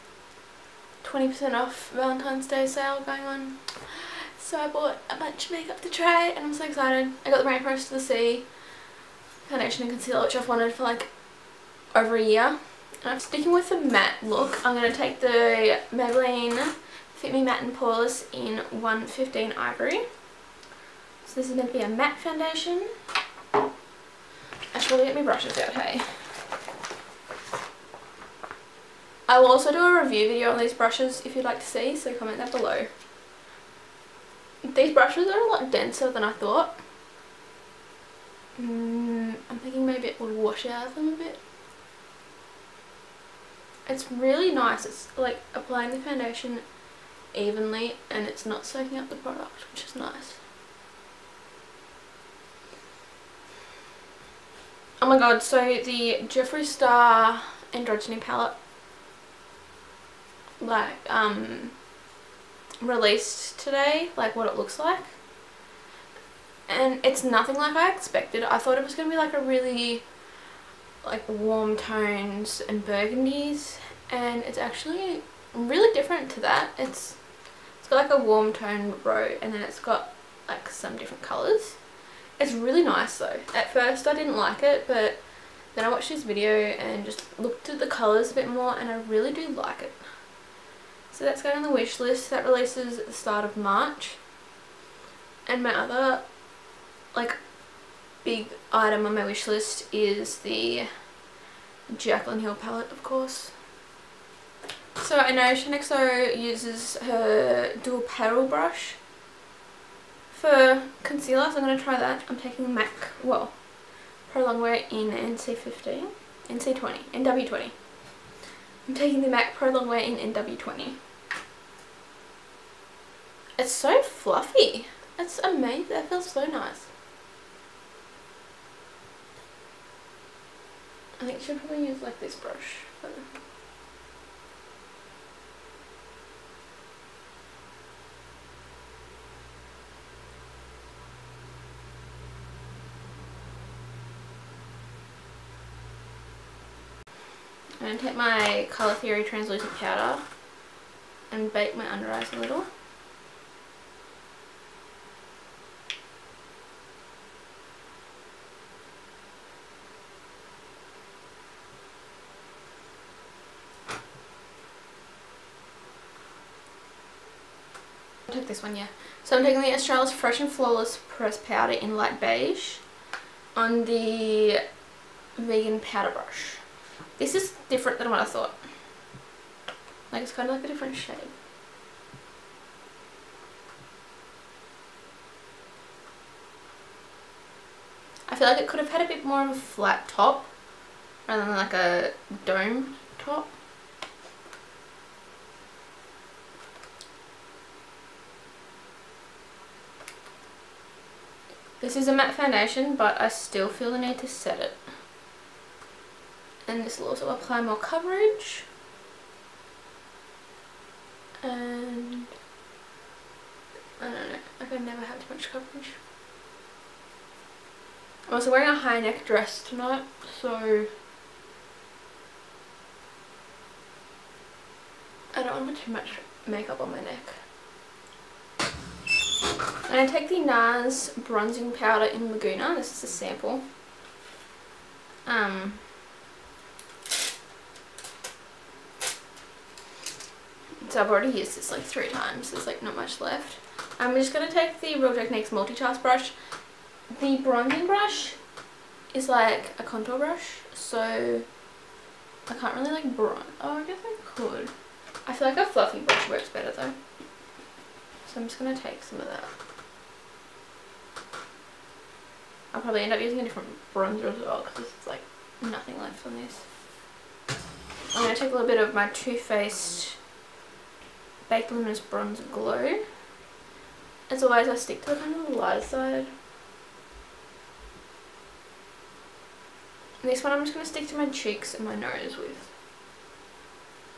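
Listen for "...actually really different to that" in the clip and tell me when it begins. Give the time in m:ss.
1:14.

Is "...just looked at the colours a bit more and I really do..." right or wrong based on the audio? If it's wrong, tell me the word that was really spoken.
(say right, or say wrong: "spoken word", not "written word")
right.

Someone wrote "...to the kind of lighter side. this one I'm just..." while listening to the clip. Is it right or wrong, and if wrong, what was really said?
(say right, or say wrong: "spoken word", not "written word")
right.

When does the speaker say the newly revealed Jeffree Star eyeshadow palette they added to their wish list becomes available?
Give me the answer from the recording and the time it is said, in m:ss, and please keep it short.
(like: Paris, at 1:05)
Start of March, at 1:33.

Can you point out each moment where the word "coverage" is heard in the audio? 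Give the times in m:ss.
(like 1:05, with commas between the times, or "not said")
3:27, 3:35.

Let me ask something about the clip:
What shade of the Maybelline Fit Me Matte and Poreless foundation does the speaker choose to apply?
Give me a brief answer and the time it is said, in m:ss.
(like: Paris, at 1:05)
115 Ivory, at 0:18.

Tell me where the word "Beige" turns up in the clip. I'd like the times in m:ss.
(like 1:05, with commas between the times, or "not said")
2:52.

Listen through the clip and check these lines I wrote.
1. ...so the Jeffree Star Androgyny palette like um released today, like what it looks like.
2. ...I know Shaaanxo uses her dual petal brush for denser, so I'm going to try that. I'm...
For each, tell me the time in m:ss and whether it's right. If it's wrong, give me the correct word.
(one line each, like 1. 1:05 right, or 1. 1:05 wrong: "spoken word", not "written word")
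1. 0:55 right
2. 1:45 wrong: "concealer", not "denser".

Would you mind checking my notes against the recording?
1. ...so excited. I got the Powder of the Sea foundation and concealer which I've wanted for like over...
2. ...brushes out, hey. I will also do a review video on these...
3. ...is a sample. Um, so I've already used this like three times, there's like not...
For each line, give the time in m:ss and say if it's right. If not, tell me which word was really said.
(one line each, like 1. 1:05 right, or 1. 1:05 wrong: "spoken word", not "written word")
1. 0:06 wrong: "Rainforest", not "Powder"
2. 0:25 right
3. 3:52 right.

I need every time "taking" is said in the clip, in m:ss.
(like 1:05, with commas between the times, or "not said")
1:52, 1:58, 2:49.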